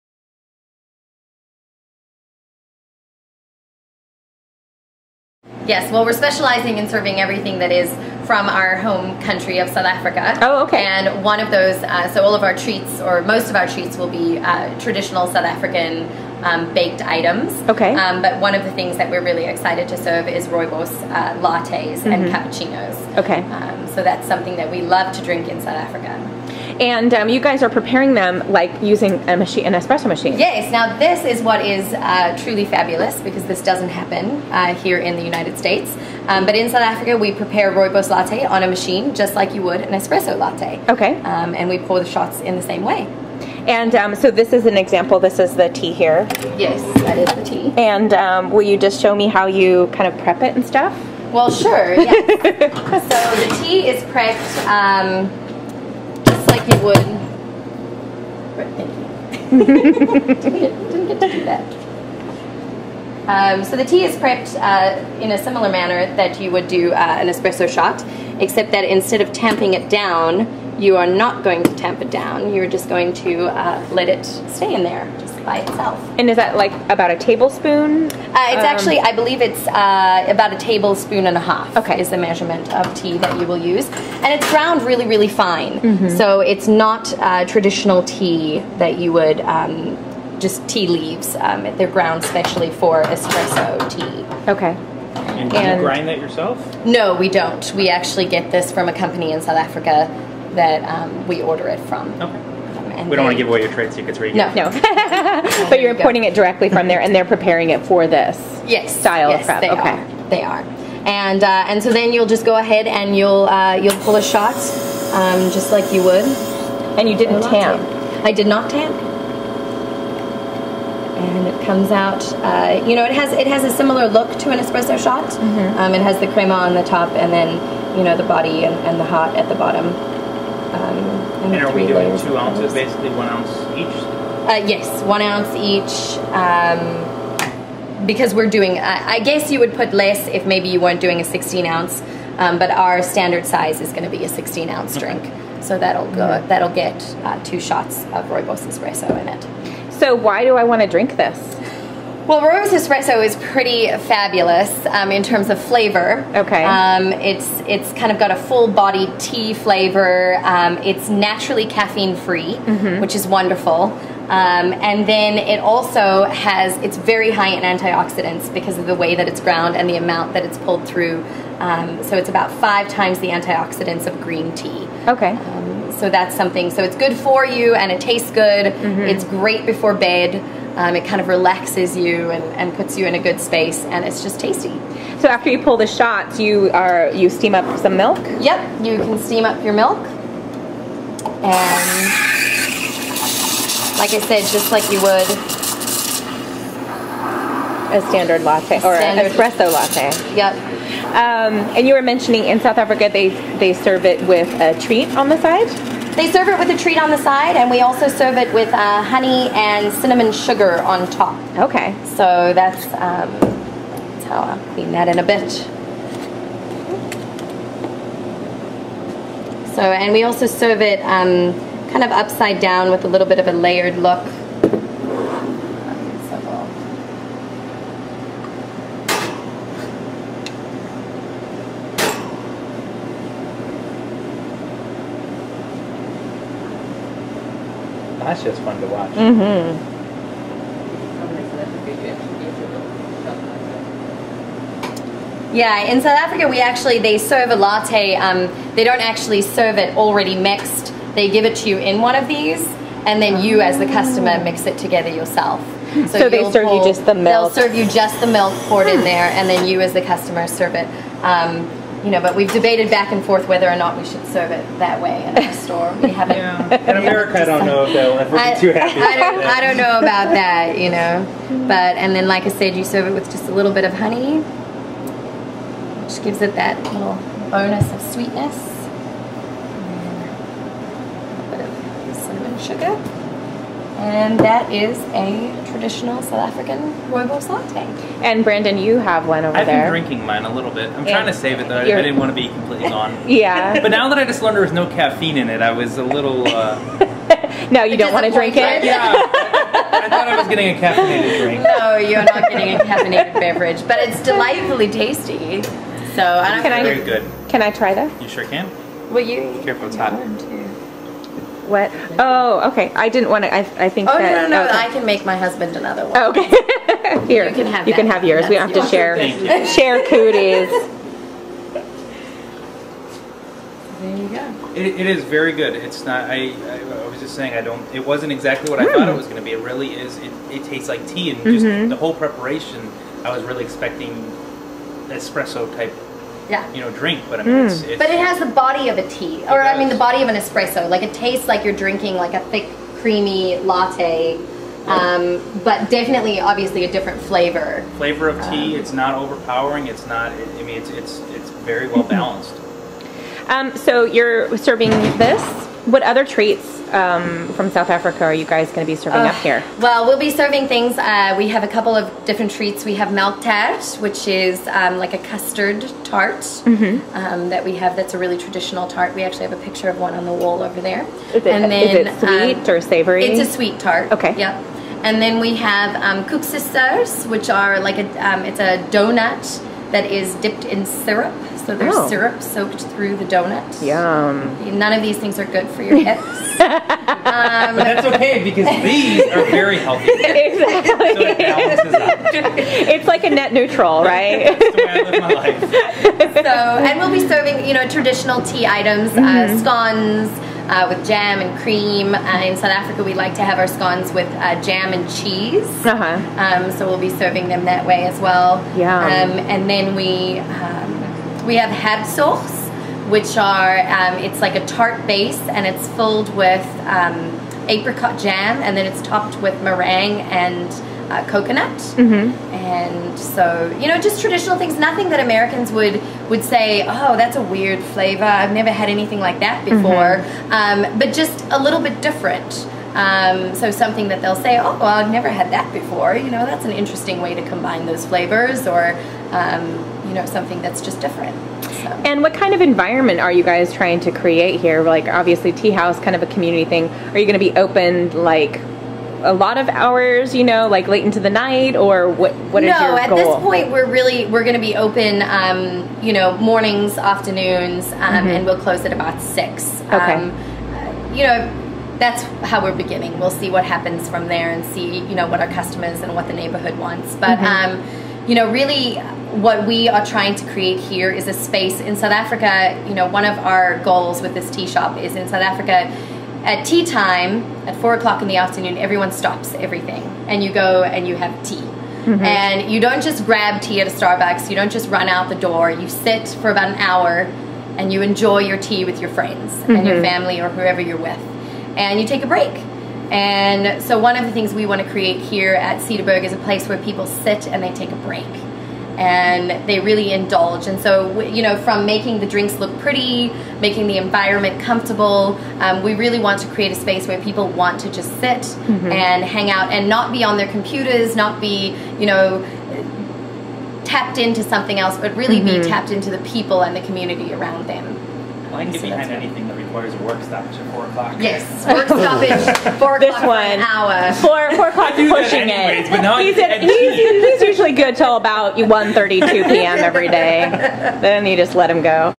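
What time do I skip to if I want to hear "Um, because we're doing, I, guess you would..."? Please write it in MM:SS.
02:16.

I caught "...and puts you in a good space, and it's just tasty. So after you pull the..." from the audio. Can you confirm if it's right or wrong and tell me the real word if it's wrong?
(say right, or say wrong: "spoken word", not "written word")
right.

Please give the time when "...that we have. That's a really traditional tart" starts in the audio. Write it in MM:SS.
06:07.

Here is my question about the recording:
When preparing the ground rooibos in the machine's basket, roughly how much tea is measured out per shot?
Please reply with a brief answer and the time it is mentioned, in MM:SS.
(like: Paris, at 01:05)
A tablespoon and a half, at 01:20.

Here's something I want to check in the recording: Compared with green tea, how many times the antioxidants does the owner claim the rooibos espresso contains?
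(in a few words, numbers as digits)
5 times.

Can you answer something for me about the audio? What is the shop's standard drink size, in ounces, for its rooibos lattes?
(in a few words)
16 ounces.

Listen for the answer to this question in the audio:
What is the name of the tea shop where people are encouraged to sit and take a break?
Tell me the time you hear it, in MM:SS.
08:15.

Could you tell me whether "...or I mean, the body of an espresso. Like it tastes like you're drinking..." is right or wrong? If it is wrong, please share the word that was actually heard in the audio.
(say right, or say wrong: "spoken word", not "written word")
right.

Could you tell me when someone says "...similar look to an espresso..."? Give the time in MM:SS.
02:03.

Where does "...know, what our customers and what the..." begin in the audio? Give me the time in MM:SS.
07:45.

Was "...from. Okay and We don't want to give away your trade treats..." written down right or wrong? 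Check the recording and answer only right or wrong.
wrong.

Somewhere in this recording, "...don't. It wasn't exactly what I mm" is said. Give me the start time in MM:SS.
05:27.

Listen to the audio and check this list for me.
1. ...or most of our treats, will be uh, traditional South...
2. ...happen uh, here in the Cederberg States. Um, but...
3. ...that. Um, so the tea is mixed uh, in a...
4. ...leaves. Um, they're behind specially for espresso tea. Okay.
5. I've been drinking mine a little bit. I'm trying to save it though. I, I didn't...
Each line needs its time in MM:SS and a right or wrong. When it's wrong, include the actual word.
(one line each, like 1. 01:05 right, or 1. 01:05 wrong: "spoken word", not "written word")
1. 00:12 right
2. 00:33 wrong: "United", not "Cederberg"
3. 01:01 wrong: "prepped", not "mixed"
4. 01:30 wrong: "ground", not "behind"
5. 04:49 right.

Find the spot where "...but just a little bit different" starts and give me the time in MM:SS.
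07:10.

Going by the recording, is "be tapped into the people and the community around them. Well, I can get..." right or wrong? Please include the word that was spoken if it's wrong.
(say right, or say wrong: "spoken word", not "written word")
right.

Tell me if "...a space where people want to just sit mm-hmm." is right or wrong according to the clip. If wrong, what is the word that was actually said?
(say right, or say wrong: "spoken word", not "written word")
right.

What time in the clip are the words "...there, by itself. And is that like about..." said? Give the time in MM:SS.
01:14.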